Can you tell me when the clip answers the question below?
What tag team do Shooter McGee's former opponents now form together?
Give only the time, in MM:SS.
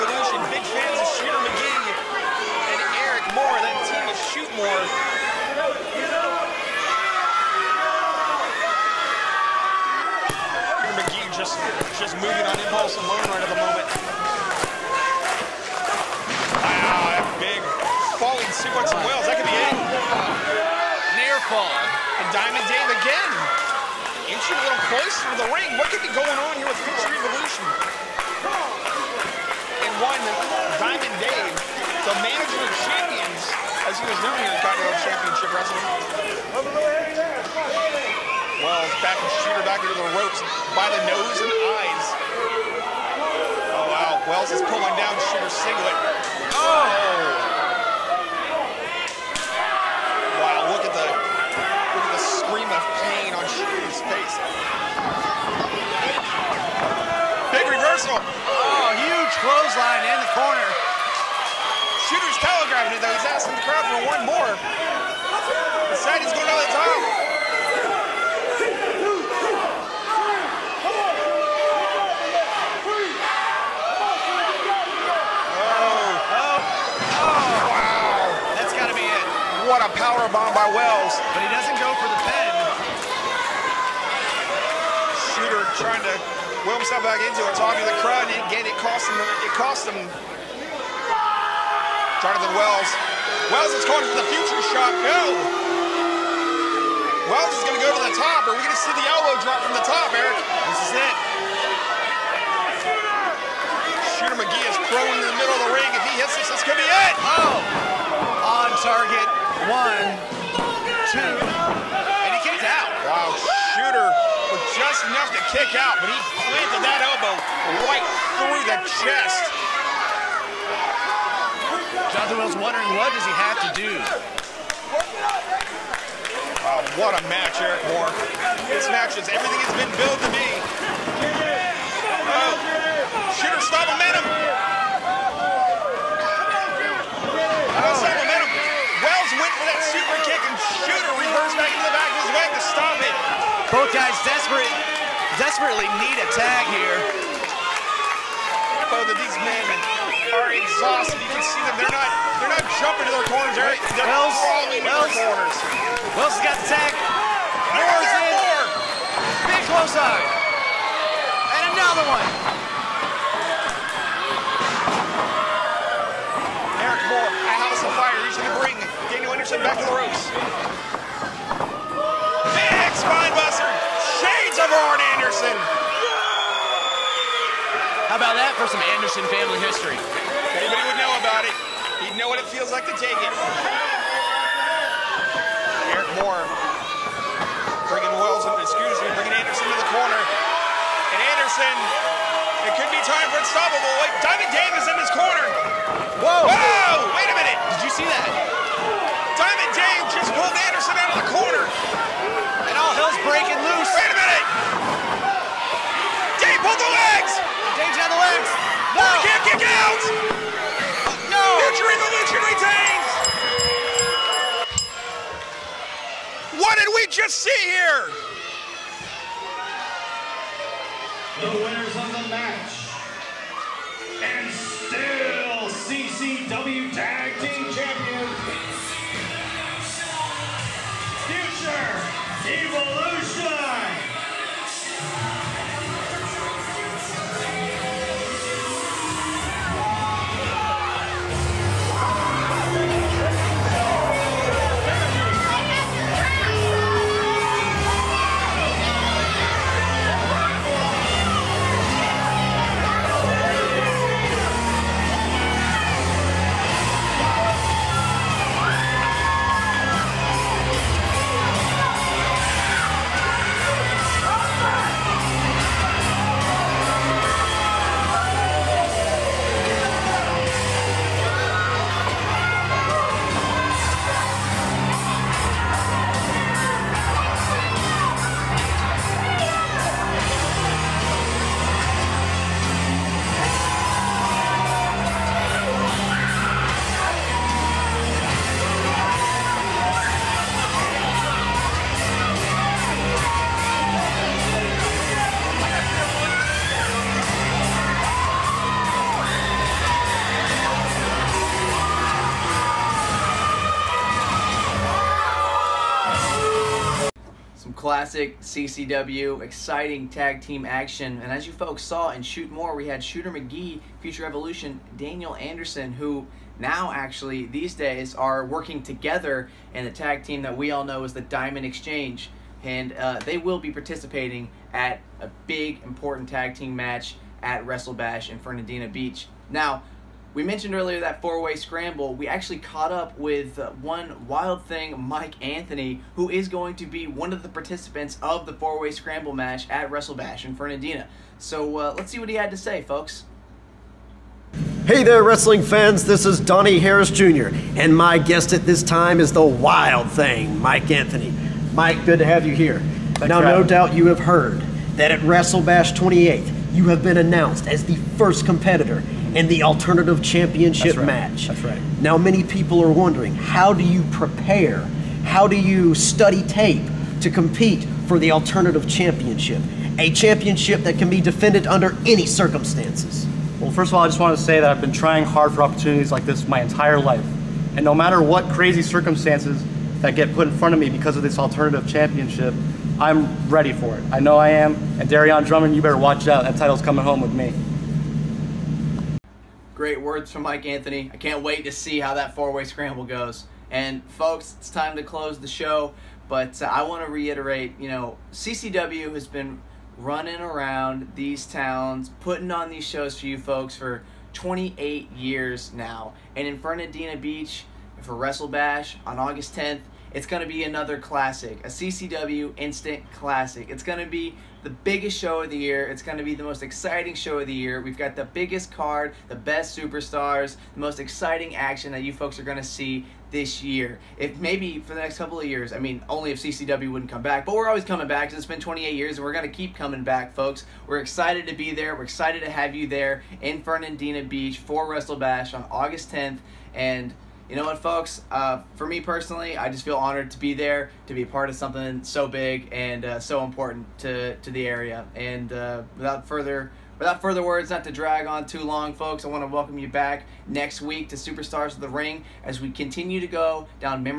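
05:21.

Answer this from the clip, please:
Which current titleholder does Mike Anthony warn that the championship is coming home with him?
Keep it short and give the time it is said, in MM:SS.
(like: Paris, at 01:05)
Darian Drummond, at 06:25.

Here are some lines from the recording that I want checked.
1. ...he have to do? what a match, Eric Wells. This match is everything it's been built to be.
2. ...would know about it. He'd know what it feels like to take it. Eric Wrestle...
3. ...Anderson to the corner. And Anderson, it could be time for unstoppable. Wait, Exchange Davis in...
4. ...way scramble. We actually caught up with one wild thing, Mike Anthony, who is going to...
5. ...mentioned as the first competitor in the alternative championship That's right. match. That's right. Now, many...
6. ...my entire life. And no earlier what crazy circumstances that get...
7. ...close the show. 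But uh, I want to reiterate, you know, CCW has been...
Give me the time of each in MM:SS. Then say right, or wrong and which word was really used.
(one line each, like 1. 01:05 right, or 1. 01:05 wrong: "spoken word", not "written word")
1. 02:03 wrong: "Moore", not "Wells"
2. 03:00 wrong: "Moore", not "Wrestle"
3. 03:09 wrong: "Diamond", not "Exchange"
4. 05:31 right
5. 05:57 wrong: "announced", not "mentioned"
6. 06:16 wrong: "matter", not "earlier"
7. 06:35 right.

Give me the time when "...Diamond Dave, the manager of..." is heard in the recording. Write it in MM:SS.
00:30.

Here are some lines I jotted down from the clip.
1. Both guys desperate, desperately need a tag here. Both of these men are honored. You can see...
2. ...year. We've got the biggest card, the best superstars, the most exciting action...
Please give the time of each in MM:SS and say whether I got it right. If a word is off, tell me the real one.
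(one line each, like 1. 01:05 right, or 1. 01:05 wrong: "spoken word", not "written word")
1. 02:23 wrong: "exhausted", not "honored"
2. 06:57 right.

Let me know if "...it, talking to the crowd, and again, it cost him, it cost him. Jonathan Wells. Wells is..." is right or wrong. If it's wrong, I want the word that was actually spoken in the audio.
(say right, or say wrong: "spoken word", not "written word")
right.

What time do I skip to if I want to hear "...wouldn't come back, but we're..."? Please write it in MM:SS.
07:06.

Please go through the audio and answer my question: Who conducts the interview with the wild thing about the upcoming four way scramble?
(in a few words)
Donnie Harris Jr.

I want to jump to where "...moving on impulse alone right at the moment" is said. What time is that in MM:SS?
00:12.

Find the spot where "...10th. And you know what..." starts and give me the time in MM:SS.
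07:16.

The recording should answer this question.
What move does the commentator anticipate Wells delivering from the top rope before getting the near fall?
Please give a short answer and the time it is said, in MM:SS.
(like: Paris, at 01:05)
Elbow drop, at 01:39.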